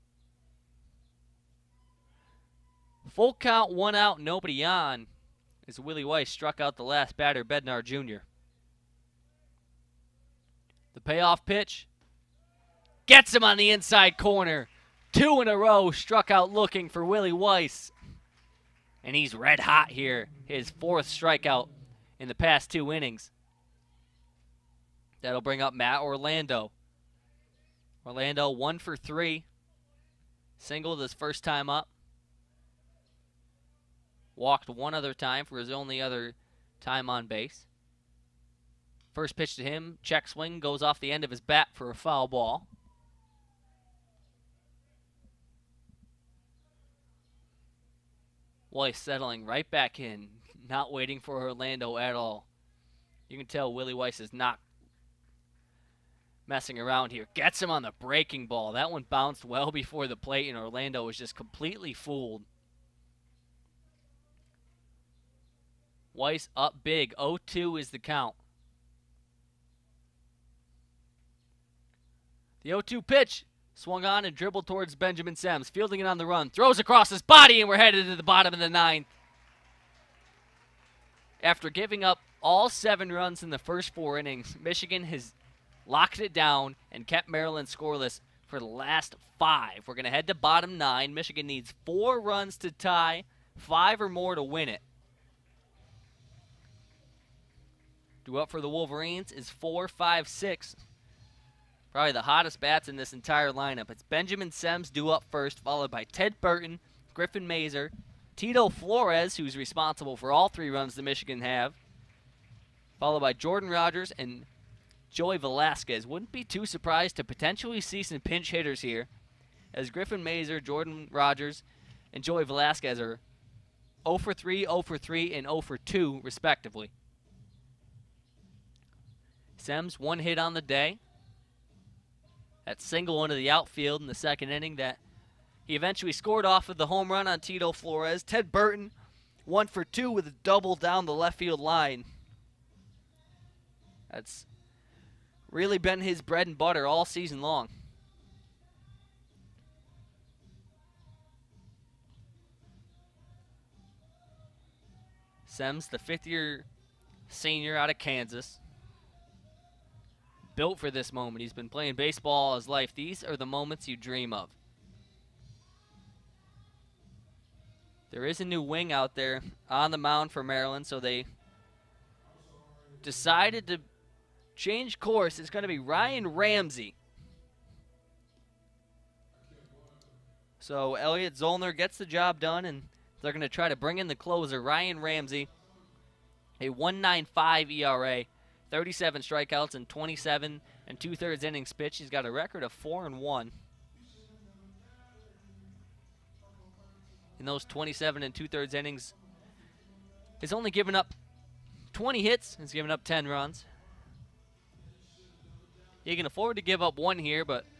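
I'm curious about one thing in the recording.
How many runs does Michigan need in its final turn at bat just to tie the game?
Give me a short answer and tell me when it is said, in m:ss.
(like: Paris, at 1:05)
4, at 1:31.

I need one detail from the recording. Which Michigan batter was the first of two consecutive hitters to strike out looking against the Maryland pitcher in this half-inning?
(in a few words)
Bednar Jr.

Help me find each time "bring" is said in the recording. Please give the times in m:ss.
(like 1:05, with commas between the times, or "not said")
0:25, 3:03.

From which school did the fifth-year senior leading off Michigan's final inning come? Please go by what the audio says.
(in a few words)
Kansas.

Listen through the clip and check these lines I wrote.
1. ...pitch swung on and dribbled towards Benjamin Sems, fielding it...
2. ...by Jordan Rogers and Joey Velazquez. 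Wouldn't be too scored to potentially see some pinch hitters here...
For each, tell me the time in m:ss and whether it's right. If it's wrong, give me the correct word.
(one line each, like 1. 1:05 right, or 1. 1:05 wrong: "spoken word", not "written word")
1. 1:13 right
2. 1:53 wrong: "surprised", not "scored".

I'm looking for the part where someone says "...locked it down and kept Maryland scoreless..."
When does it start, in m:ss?
1:25.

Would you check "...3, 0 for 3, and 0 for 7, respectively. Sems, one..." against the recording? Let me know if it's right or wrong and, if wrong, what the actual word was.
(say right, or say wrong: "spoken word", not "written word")
wrong: "2", not "7".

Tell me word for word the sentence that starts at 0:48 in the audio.
Well, he's settling right back in not waiting for Orlando at all.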